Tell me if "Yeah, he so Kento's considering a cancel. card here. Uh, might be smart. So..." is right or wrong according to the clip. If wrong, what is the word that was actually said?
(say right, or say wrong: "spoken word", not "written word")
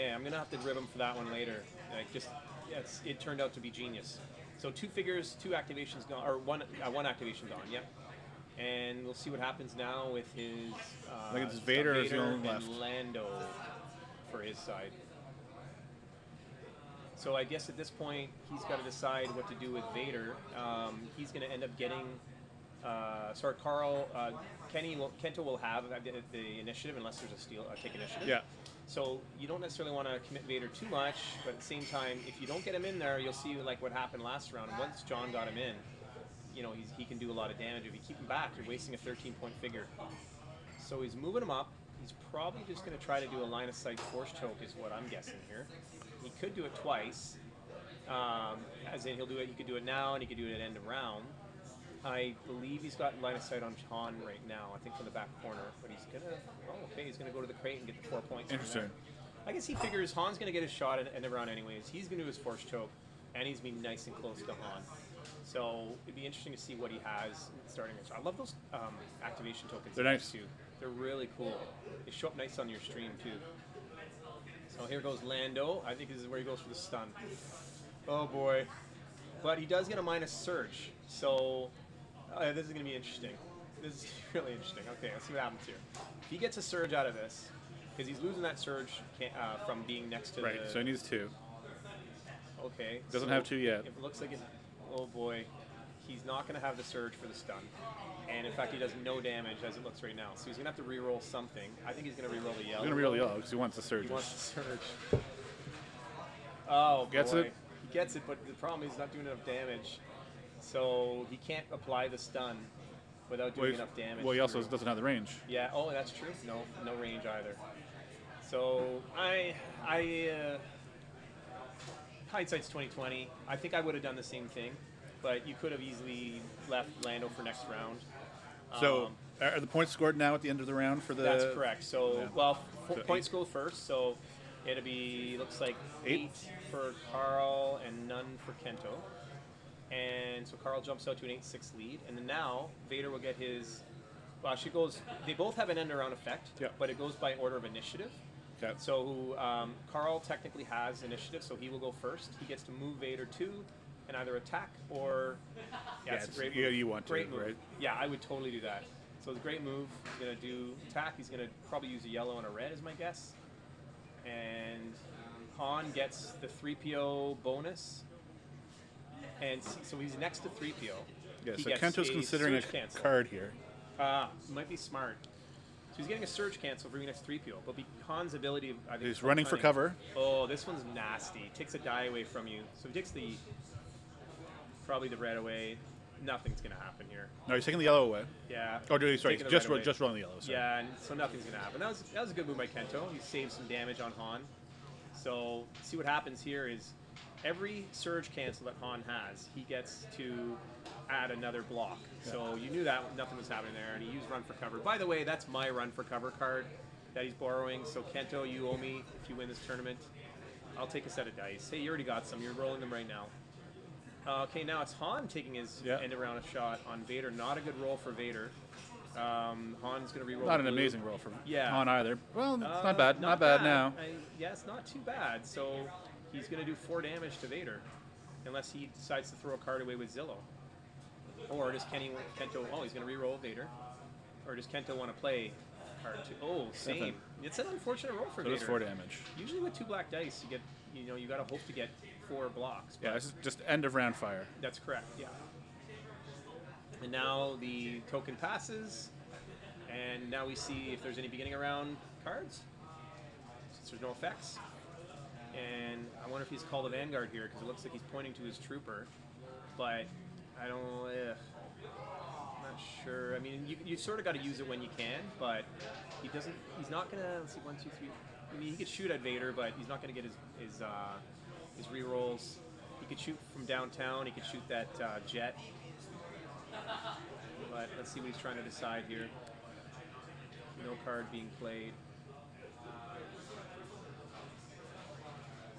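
right.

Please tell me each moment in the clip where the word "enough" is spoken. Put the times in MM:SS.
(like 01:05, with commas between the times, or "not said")
01:49, 01:53.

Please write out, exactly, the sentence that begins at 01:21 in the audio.
So uh, this is going to be interesting.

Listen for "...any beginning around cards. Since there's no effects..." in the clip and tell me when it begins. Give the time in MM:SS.
04:11.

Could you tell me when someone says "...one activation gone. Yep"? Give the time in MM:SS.
00:06.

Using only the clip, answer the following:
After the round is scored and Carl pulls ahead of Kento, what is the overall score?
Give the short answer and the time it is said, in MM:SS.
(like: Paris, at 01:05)
8 6, at 02:21.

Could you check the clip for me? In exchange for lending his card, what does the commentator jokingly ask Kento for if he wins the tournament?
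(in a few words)
A set of dice.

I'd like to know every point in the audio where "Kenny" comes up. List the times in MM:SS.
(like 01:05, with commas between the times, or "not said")
00:24, 03:51.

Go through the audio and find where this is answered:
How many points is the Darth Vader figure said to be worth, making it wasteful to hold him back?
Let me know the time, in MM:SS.
00:38.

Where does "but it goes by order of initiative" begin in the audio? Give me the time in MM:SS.
02:26.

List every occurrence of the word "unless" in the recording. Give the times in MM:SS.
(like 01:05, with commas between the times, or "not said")
00:26, 03:48.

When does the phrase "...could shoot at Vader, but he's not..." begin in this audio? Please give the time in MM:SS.
04:28.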